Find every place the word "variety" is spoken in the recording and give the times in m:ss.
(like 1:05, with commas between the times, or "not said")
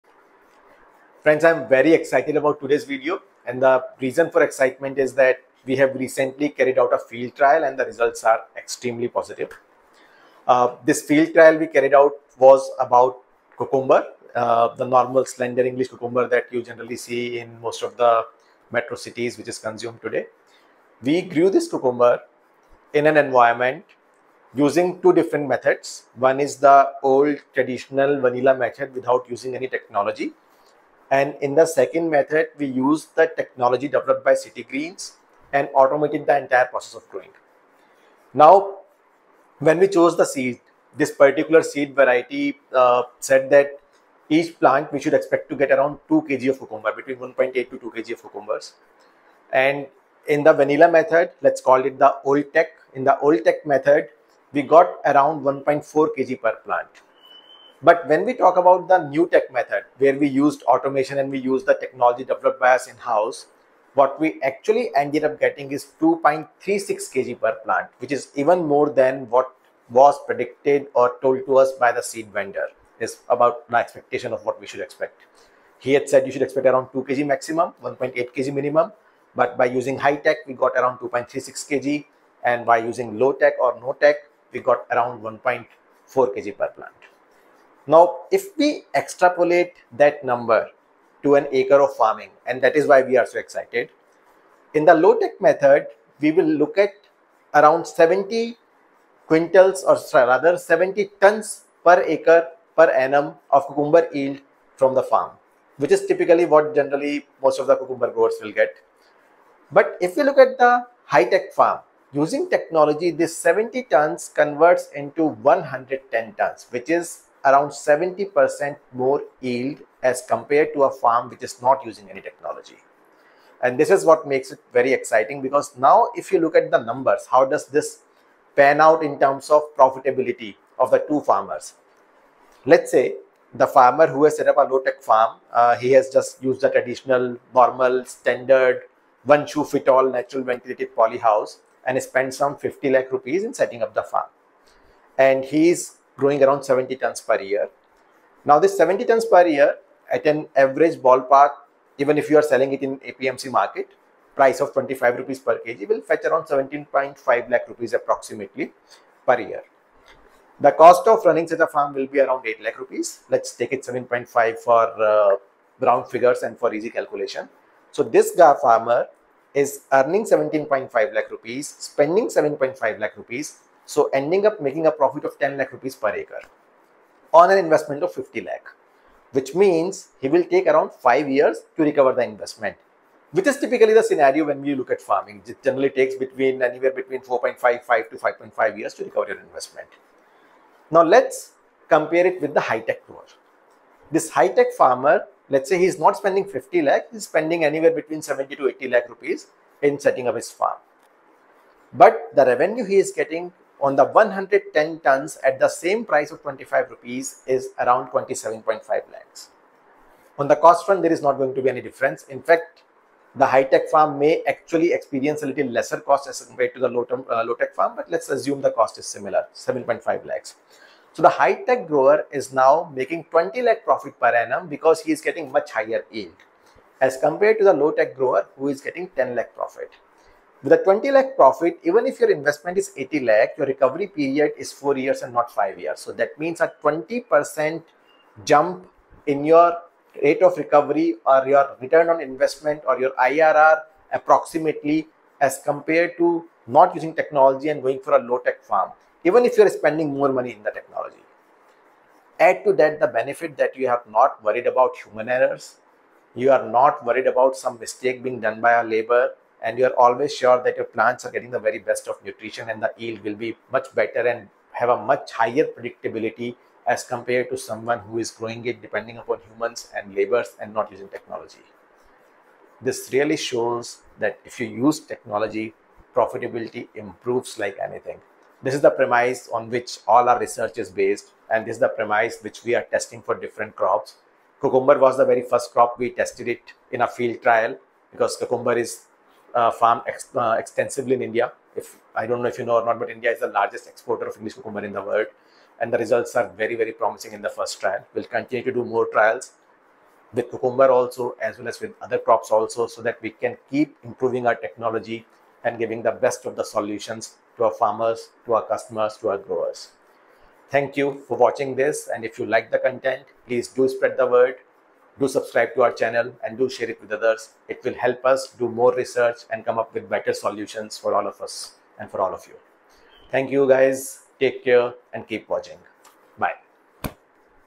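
0:41.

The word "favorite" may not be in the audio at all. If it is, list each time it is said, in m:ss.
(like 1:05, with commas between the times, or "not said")
not said.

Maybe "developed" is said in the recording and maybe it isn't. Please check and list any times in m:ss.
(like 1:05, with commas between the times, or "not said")
0:33, 1:02.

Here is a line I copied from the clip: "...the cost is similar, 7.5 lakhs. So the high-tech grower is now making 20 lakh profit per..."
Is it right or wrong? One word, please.
right.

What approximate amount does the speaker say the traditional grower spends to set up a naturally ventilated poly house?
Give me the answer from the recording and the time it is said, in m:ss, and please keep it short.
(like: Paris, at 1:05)
50 lakh rupees, at 2:22.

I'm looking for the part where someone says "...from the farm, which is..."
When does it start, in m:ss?
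1:44.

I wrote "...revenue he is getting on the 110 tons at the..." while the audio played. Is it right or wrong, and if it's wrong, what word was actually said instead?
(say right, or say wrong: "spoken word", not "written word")
right.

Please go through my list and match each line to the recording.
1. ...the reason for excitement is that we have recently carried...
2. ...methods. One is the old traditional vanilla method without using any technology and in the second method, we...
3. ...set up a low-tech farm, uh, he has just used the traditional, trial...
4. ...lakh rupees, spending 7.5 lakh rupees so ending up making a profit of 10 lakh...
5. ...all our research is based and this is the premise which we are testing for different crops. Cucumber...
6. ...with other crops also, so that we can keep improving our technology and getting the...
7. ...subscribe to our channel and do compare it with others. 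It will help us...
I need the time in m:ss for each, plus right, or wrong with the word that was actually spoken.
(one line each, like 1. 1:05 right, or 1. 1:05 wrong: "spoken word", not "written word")
1. 0:03 right
2. 0:25 right
3. 2:14 wrong: "normal", not "trial"
4. 2:51 right
5. 4:40 right
6. 5:01 wrong: "giving", not "getting"
7. 5:15 wrong: "share", not "compare".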